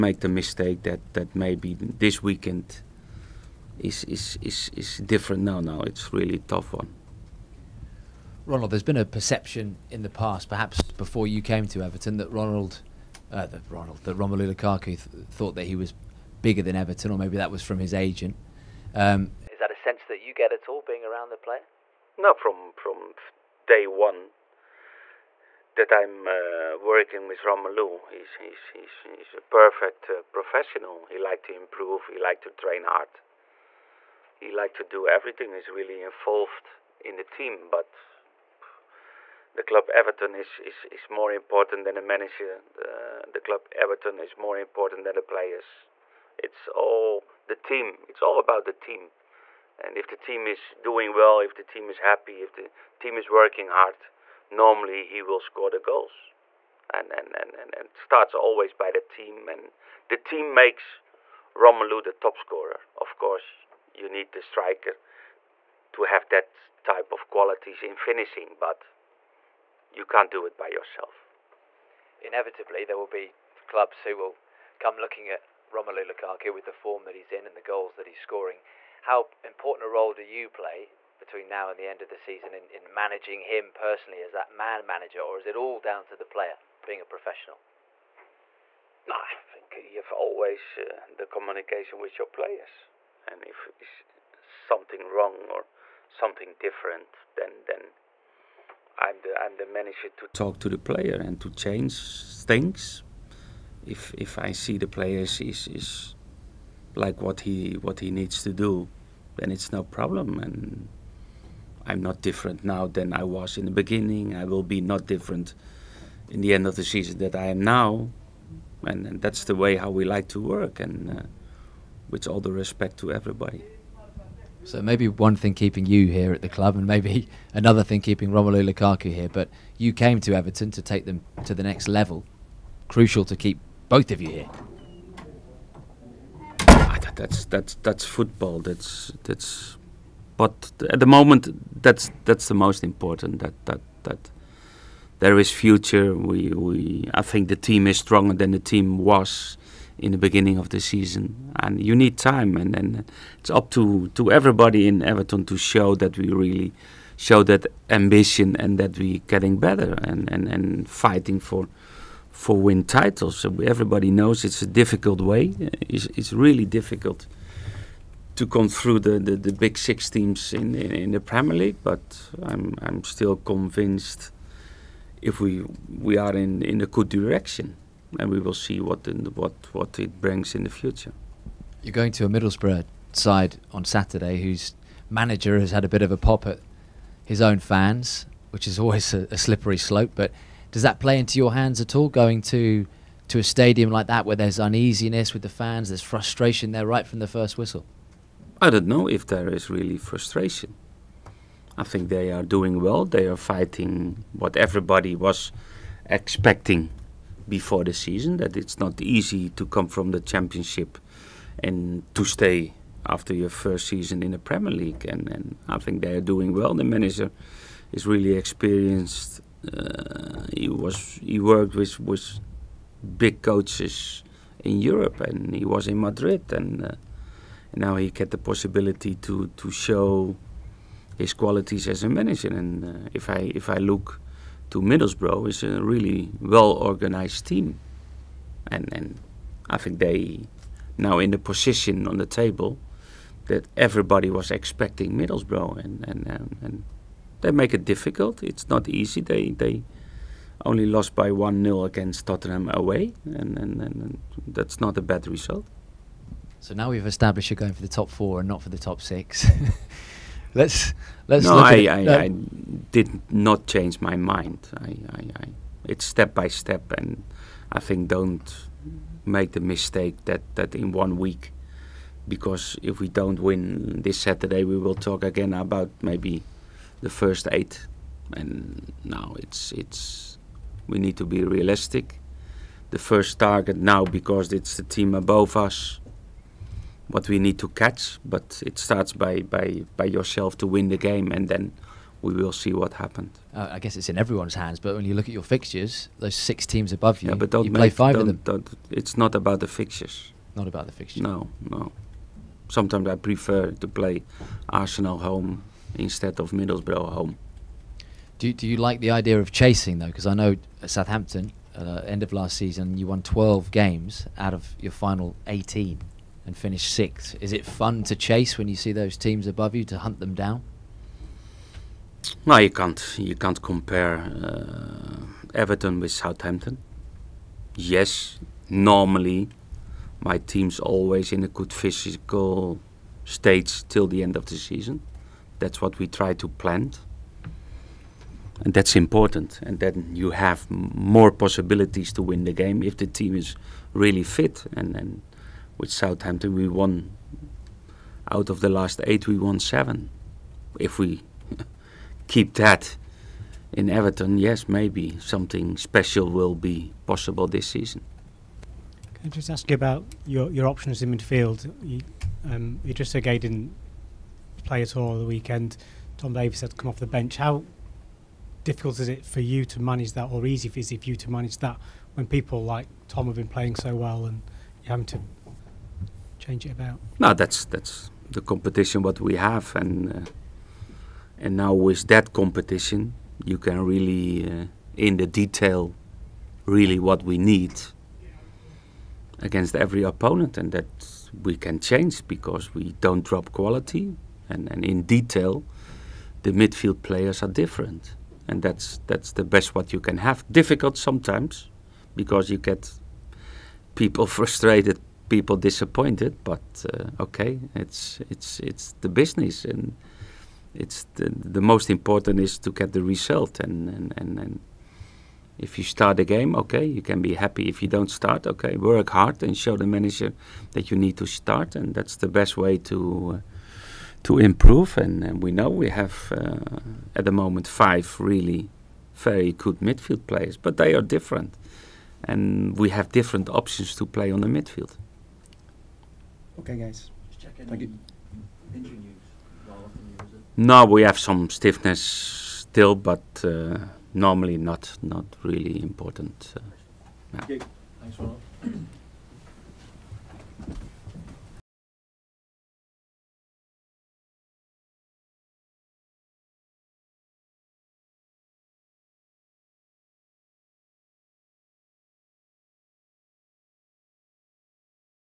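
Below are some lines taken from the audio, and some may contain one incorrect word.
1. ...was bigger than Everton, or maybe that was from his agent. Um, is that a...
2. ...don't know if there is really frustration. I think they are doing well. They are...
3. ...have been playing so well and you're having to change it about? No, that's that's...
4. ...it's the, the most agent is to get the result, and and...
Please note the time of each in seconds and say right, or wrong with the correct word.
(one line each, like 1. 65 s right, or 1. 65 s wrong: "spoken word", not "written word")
1. 15 s right
2. 198 s right
3. 373 s right
4. 410 s wrong: "important", not "agent".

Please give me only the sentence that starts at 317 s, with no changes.
Is it fun to chase when you see those teams above you to hunt them down?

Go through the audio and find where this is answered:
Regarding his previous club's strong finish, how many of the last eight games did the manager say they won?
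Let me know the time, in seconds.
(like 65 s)
349 s.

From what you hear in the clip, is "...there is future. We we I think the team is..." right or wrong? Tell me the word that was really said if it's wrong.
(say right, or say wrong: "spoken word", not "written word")
right.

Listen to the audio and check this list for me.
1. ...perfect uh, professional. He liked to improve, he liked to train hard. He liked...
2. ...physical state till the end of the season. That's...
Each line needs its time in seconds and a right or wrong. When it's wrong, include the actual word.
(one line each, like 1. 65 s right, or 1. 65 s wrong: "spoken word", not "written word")
1. 29 s right
2. 331 s right.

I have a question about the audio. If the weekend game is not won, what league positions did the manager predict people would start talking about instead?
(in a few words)
the first eight.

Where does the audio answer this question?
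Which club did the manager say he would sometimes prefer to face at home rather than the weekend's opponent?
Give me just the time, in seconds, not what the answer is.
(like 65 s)
304 s.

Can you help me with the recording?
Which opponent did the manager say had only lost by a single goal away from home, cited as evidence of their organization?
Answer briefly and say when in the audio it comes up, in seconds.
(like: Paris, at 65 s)
Tottenham, at 252 s.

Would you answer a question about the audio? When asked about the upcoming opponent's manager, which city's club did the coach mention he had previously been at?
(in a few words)
Madrid.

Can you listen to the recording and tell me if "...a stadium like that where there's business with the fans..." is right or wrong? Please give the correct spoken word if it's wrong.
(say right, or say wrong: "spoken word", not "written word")
wrong: "uneasiness", not "business".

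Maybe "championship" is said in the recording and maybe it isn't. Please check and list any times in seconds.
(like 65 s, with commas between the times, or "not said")
210 s.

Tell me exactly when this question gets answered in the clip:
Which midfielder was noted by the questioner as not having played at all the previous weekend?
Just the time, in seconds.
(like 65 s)
362 s.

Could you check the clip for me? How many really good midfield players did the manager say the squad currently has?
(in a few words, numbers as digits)
5.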